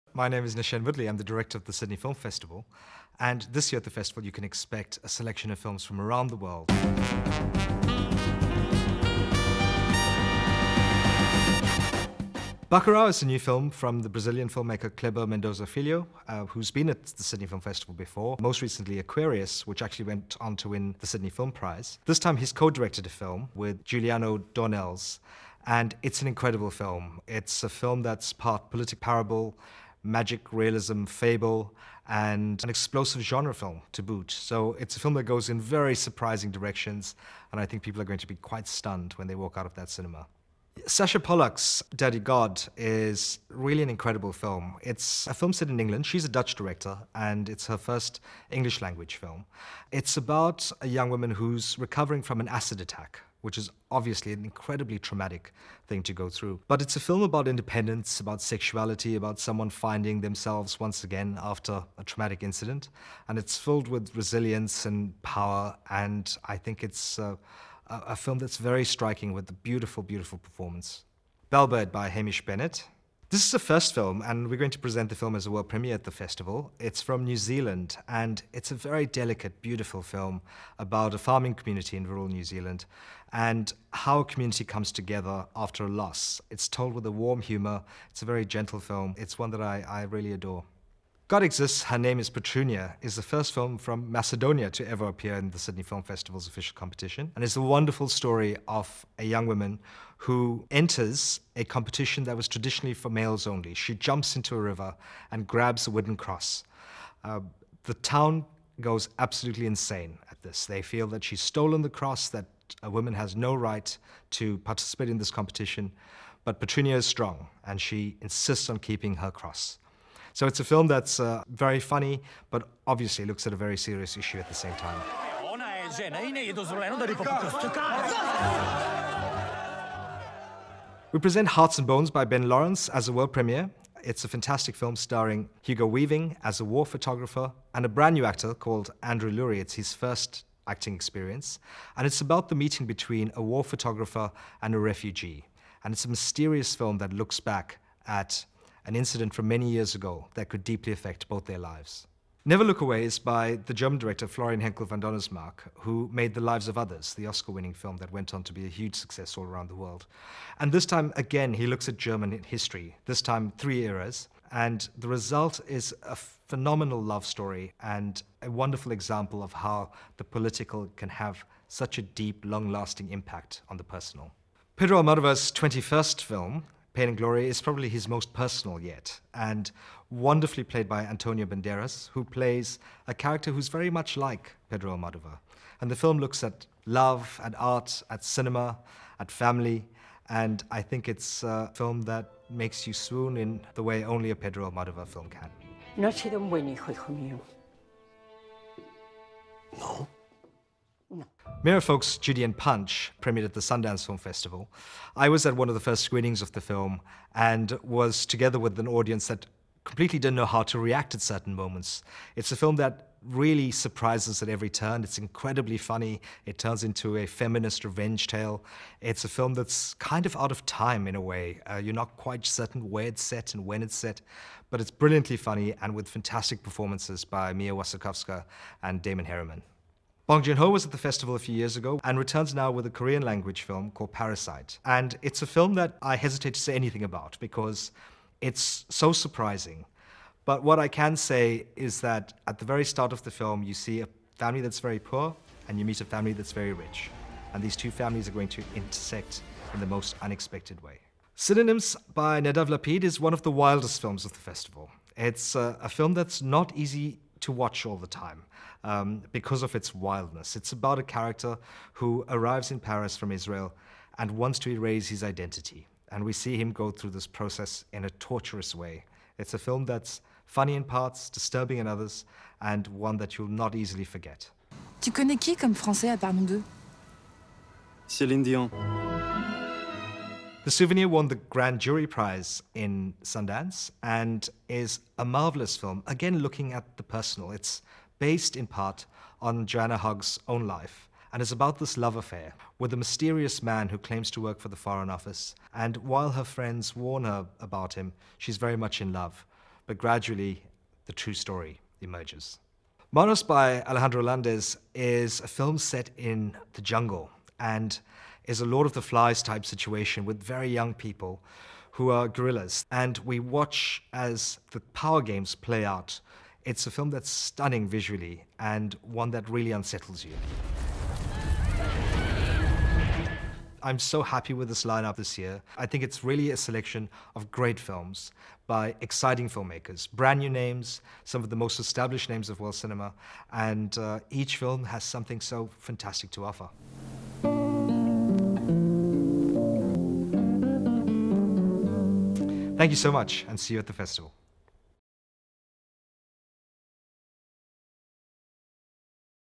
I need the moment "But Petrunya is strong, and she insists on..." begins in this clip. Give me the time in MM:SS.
01:56.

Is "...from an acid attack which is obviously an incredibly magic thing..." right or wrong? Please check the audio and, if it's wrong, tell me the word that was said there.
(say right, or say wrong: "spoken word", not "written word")
wrong: "traumatic", not "magic".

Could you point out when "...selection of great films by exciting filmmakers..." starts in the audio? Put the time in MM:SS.
05:26.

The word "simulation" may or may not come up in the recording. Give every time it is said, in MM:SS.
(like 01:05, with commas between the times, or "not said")
not said.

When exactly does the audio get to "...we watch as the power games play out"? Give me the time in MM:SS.
05:13.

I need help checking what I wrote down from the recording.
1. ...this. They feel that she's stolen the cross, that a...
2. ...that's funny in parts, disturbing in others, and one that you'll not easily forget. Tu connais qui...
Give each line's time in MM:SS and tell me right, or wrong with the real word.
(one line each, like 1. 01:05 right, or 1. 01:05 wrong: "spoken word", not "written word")
1. 01:50 right
2. 04:29 right.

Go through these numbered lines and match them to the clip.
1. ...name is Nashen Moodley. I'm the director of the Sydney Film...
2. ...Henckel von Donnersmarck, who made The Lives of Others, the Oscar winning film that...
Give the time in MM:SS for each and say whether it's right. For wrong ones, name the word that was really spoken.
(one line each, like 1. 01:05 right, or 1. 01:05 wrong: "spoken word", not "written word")
1. 00:00 right
2. 02:34 right.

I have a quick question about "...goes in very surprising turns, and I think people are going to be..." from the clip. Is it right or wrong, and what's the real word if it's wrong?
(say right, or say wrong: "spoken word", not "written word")
wrong: "directions", not "turns".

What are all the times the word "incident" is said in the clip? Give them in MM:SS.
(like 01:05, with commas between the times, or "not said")
01:02, 02:28.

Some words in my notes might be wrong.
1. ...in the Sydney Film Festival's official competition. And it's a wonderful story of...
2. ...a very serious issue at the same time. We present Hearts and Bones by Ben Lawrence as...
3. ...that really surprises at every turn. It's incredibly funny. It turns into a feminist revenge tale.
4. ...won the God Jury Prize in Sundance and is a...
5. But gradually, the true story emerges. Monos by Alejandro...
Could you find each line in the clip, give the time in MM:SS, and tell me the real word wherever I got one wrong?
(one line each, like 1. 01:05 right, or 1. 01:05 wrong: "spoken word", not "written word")
1. 01:35 right
2. 02:03 right
3. 03:32 right
4. 04:41 wrong: "Grand", not "God"
5. 04:59 right.